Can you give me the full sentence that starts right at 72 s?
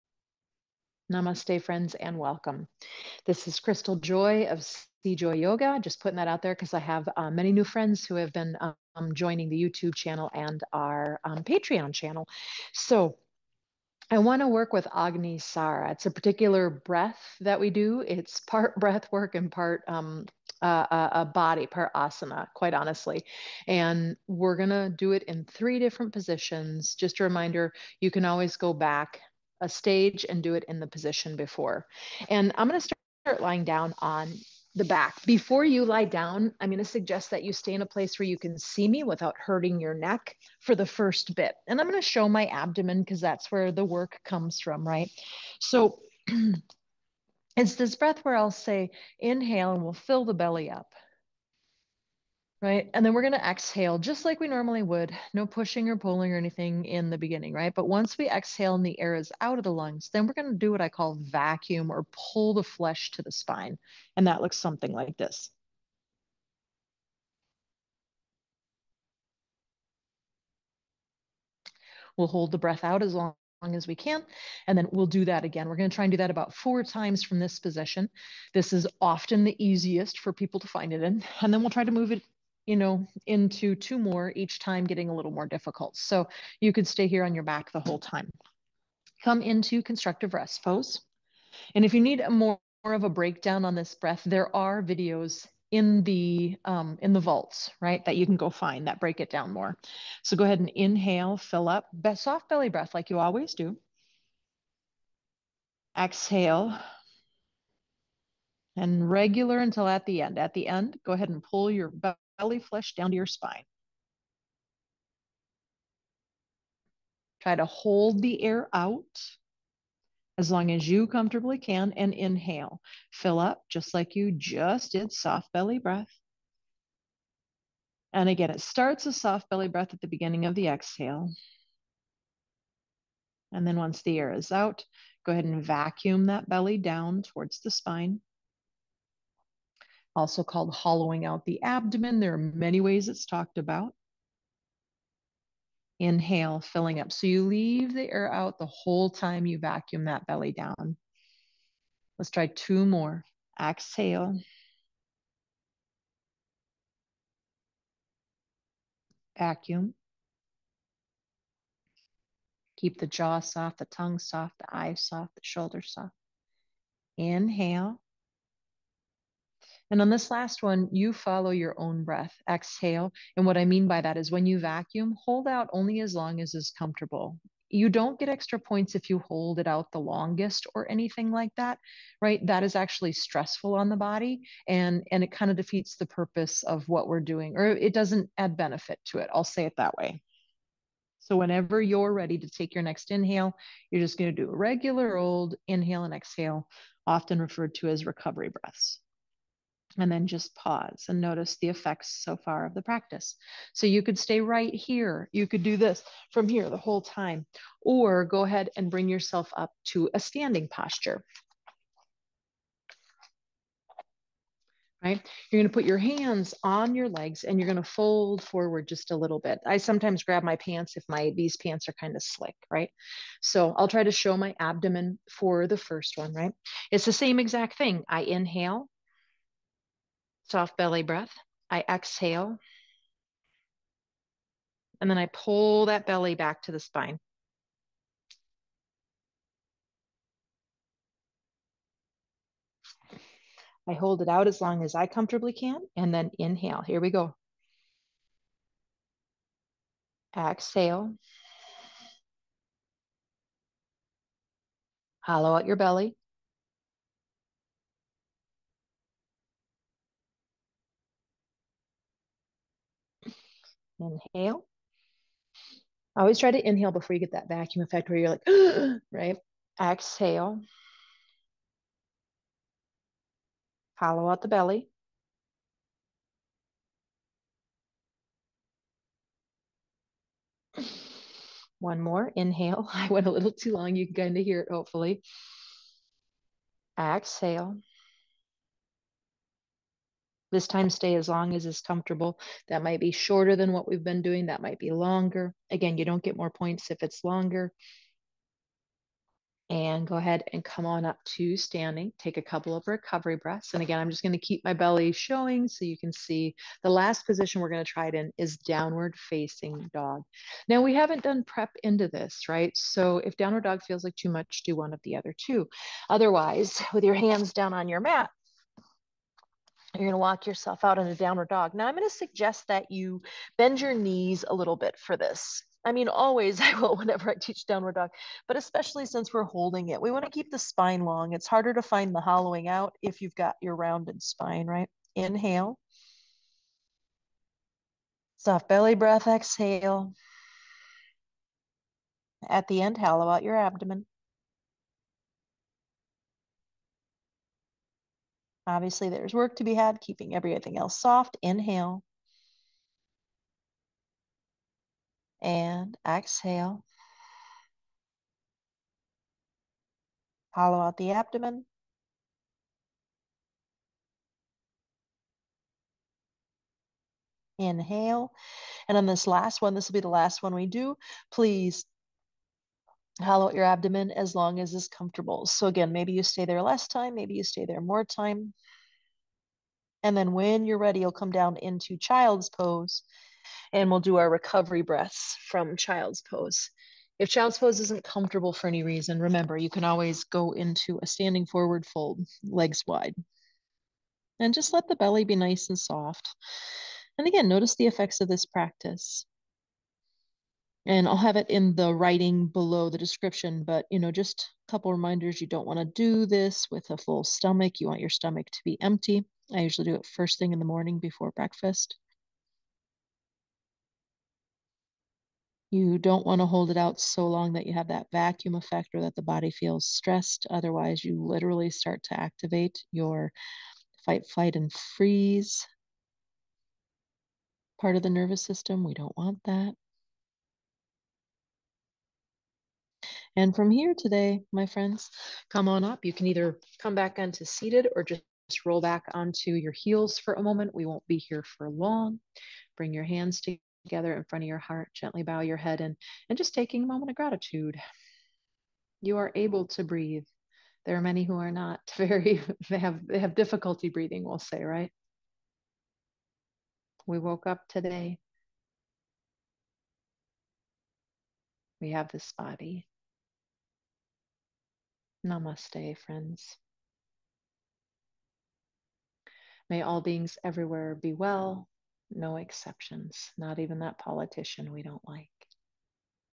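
We'll hold the breath out as long as we can.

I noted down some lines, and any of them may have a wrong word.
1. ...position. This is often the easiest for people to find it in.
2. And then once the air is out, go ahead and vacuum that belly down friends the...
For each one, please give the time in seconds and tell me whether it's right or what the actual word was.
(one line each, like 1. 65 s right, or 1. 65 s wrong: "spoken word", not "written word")
1. 77 s right
2. 133 s wrong: "towards", not "friends".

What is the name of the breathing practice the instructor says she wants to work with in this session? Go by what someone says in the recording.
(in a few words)
Agni Sara.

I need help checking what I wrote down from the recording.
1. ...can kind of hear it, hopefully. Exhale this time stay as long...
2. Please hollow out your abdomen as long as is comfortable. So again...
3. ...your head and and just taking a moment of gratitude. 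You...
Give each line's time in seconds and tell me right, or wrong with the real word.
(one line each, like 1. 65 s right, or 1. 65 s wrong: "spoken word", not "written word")
1. 284 s right
2. 371 s right
3. 445 s right.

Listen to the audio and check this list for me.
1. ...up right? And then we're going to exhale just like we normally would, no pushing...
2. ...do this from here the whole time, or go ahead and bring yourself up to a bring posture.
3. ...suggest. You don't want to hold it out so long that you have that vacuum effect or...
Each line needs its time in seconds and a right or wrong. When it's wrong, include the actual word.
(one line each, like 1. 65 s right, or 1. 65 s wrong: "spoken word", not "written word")
1. 50 s right
2. 205 s wrong: "standing", not "bring"
3. 411 s wrong: "breakfast", not "suggest".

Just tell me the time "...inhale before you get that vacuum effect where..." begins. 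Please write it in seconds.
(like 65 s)
266 s.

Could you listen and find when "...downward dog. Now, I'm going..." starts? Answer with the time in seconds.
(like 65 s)
321 s.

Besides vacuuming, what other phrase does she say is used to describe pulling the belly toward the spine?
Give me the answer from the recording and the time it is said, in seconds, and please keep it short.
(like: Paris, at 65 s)
Hollowing out the abdomen, at 140 s.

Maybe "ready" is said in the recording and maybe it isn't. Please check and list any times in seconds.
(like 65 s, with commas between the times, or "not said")
192 s, 380 s.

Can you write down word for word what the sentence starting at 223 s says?
So I'll try to show my abdomen for the first one, right?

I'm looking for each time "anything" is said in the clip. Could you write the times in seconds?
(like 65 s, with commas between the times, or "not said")
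56 s, 180 s.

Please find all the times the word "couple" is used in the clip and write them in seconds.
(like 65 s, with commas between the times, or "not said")
302 s, 404 s.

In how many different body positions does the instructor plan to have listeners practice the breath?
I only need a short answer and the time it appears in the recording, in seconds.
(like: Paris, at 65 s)
3, at 25 s.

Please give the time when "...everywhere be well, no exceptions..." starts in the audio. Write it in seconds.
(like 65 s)
470 s.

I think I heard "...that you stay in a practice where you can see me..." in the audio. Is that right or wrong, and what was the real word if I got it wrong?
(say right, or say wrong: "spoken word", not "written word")
wrong: "place", not "practice".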